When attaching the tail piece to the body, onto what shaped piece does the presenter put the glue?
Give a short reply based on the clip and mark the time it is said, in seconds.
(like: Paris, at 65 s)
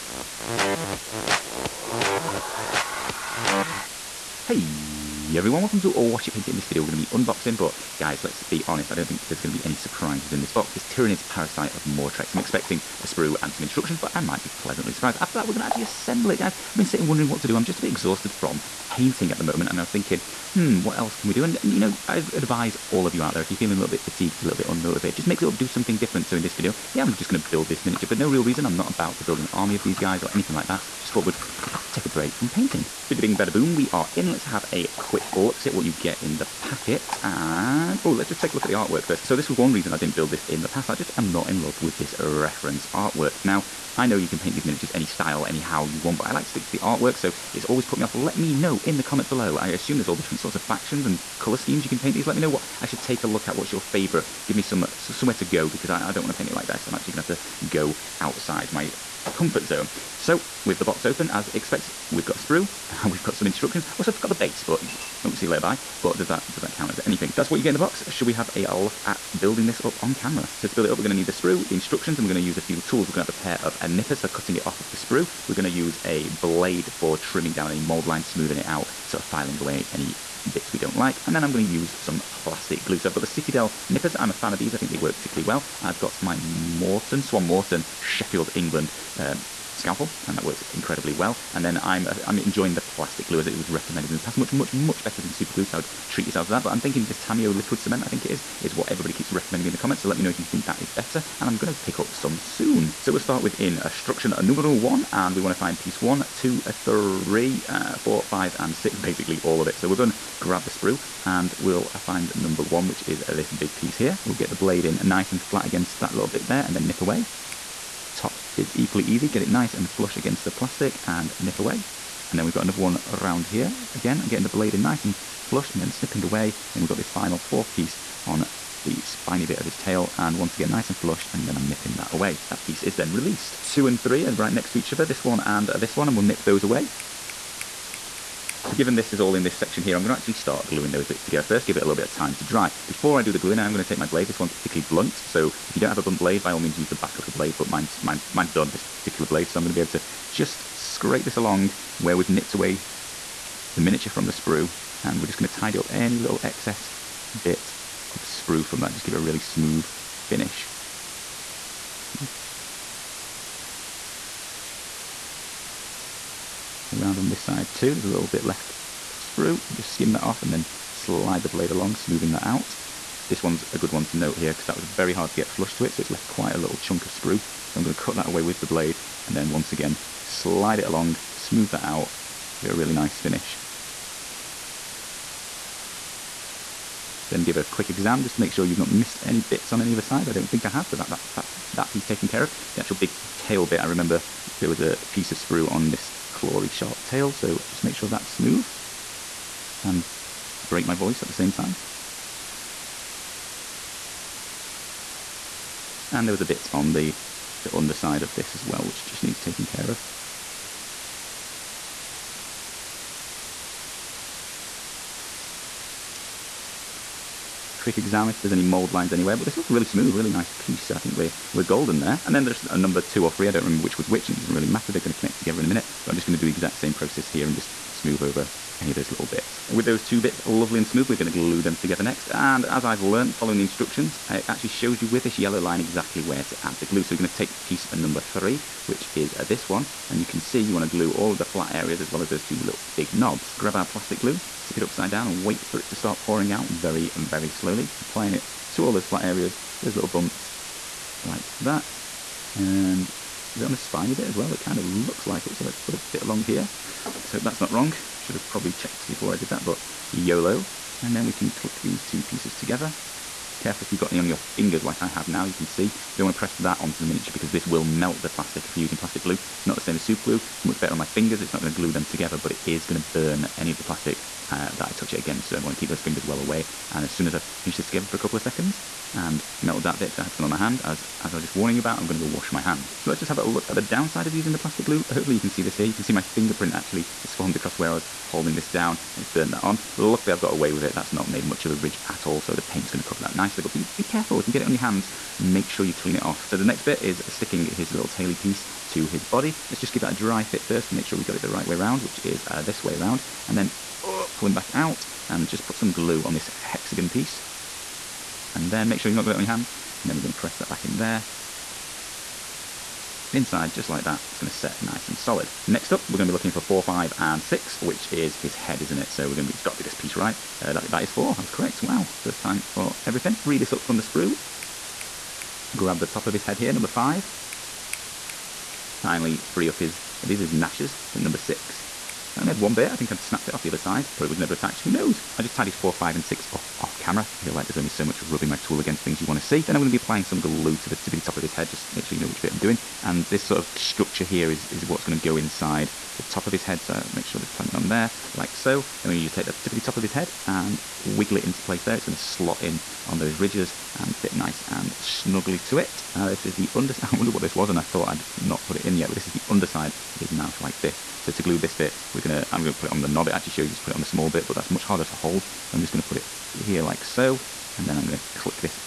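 hexagon, at 306 s.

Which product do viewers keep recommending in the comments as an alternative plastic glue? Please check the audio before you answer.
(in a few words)
Tamiya liquid cement.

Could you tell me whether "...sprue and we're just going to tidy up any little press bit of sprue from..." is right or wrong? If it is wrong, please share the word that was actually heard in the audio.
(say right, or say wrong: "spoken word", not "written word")
wrong: "excess", not "press".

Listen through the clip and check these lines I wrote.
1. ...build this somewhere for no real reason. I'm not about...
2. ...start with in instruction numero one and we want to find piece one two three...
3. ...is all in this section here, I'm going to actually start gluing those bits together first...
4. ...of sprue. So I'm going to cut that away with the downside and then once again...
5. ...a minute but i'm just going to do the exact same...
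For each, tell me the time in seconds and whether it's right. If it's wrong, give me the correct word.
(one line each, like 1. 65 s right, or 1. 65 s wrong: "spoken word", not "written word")
1. 27 s wrong: "miniature", not "somewhere"
2. 103 s right
3. 139 s right
4. 177 s wrong: "blade", not "downside"
5. 225 s right.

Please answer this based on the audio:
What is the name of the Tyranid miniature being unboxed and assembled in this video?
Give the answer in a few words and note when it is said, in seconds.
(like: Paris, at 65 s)
Parasite of Mortrex, at 11 s.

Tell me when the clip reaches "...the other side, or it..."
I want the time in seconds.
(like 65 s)
333 s.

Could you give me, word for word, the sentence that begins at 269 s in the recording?
It's not the same as super glue.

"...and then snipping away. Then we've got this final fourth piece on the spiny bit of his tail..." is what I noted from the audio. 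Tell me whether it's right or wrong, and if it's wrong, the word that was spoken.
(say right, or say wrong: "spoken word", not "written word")
right.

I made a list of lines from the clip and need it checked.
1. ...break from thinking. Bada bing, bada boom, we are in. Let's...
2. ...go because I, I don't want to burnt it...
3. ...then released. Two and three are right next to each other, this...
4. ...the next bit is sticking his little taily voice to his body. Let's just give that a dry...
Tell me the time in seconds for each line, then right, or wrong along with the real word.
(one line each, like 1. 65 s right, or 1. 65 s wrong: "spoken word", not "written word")
1. 32 s wrong: "painting", not "thinking"
2. 55 s wrong: "paint", not "burnt"
3. 132 s right
4. 296 s wrong: "piece", not "voice".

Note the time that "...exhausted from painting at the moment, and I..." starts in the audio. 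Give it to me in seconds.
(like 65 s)
17 s.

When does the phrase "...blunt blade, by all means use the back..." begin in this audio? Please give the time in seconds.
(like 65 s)
146 s.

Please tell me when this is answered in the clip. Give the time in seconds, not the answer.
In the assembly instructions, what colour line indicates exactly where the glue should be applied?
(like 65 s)
235 s.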